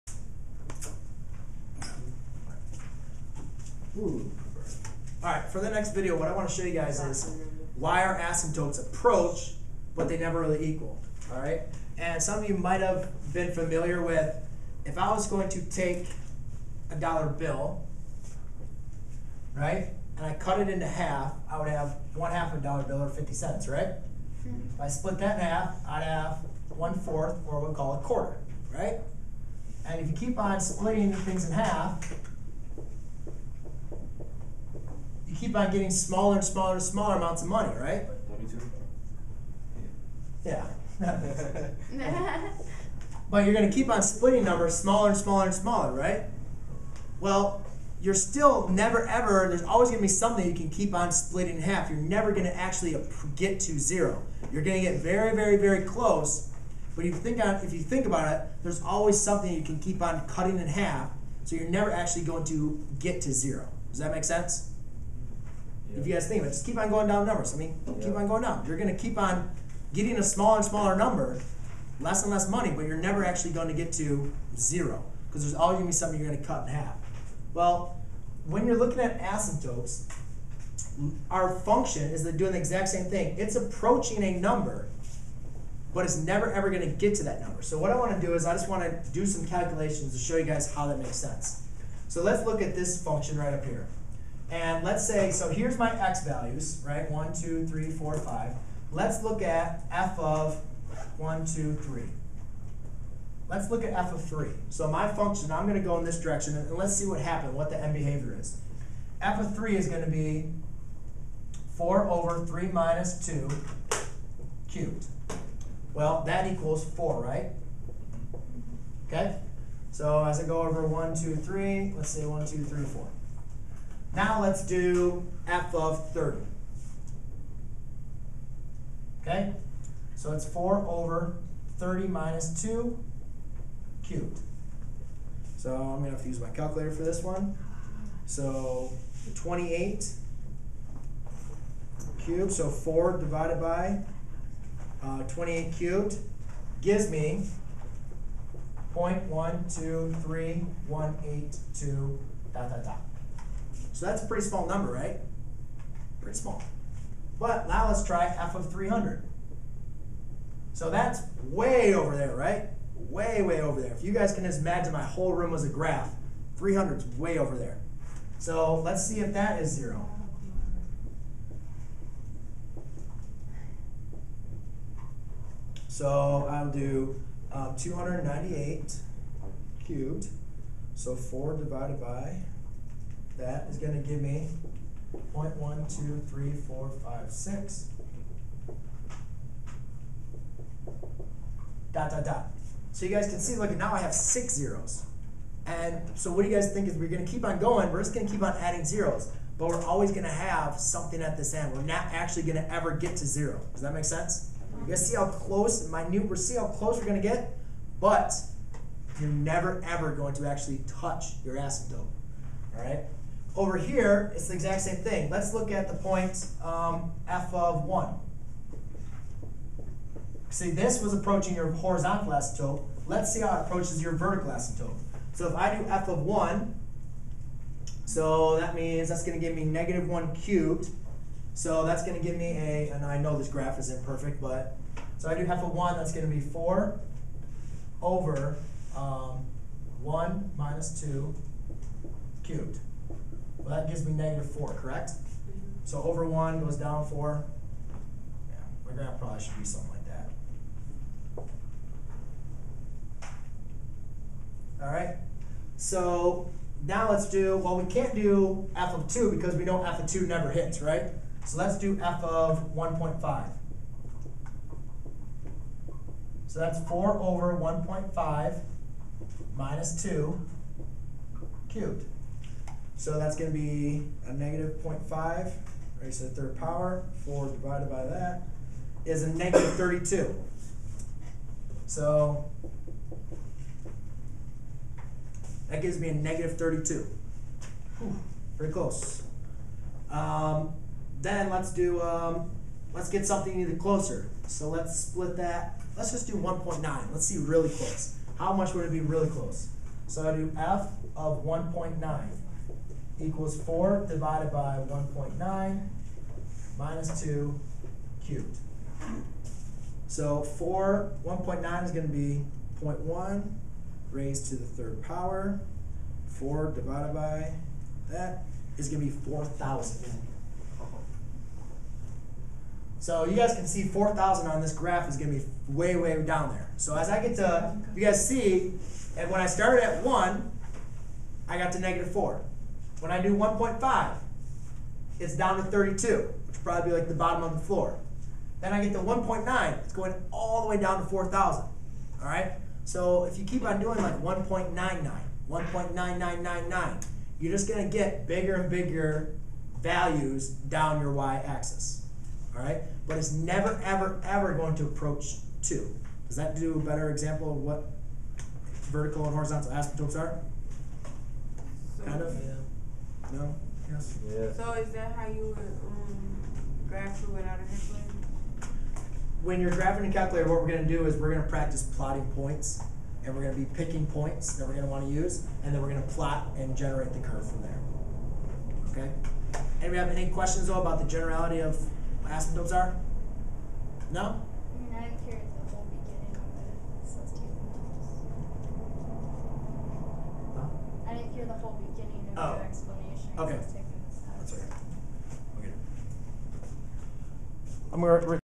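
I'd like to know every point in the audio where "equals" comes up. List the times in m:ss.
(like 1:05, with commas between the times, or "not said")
0:10, 1:56, 5:03.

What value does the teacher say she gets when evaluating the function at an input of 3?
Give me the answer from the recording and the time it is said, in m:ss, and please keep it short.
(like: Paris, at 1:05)
4, at 1:56.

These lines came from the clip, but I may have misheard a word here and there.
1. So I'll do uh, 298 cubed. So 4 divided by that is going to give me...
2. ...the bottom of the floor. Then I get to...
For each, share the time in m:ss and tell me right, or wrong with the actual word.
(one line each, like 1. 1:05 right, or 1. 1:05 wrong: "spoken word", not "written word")
1. 2:55 right
2. 5:37 right.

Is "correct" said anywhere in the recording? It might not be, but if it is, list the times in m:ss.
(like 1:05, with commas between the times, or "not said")
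4:04.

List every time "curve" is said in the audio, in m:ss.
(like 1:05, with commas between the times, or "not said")
6:17.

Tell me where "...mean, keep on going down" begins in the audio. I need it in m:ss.
1:07.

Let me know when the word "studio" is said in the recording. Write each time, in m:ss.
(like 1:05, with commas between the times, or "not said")
not said.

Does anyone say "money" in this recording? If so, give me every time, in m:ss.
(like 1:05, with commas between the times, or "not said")
0:37, 1:12.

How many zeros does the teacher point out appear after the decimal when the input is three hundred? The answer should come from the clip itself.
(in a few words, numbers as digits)
6.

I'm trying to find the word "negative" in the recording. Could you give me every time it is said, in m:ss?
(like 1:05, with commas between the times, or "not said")
3:49, 4:04, 4:34, 4:39, 4:46, 5:31.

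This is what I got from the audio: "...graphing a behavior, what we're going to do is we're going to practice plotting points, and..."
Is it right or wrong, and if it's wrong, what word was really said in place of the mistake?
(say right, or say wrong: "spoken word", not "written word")
wrong: "calculator", not "behavior".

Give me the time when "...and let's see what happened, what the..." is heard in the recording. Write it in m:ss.
1:46.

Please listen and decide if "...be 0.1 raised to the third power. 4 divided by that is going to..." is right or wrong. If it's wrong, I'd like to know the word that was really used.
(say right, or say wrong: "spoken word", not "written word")
right.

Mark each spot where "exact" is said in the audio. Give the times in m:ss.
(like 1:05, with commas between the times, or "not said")
1:22, 3:34.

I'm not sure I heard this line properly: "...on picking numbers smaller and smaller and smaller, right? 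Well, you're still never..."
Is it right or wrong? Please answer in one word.
wrong.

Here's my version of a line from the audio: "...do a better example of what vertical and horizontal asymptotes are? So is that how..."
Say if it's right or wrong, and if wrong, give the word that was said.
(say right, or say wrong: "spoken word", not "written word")
right.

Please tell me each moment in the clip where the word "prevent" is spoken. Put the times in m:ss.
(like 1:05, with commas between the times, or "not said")
not said.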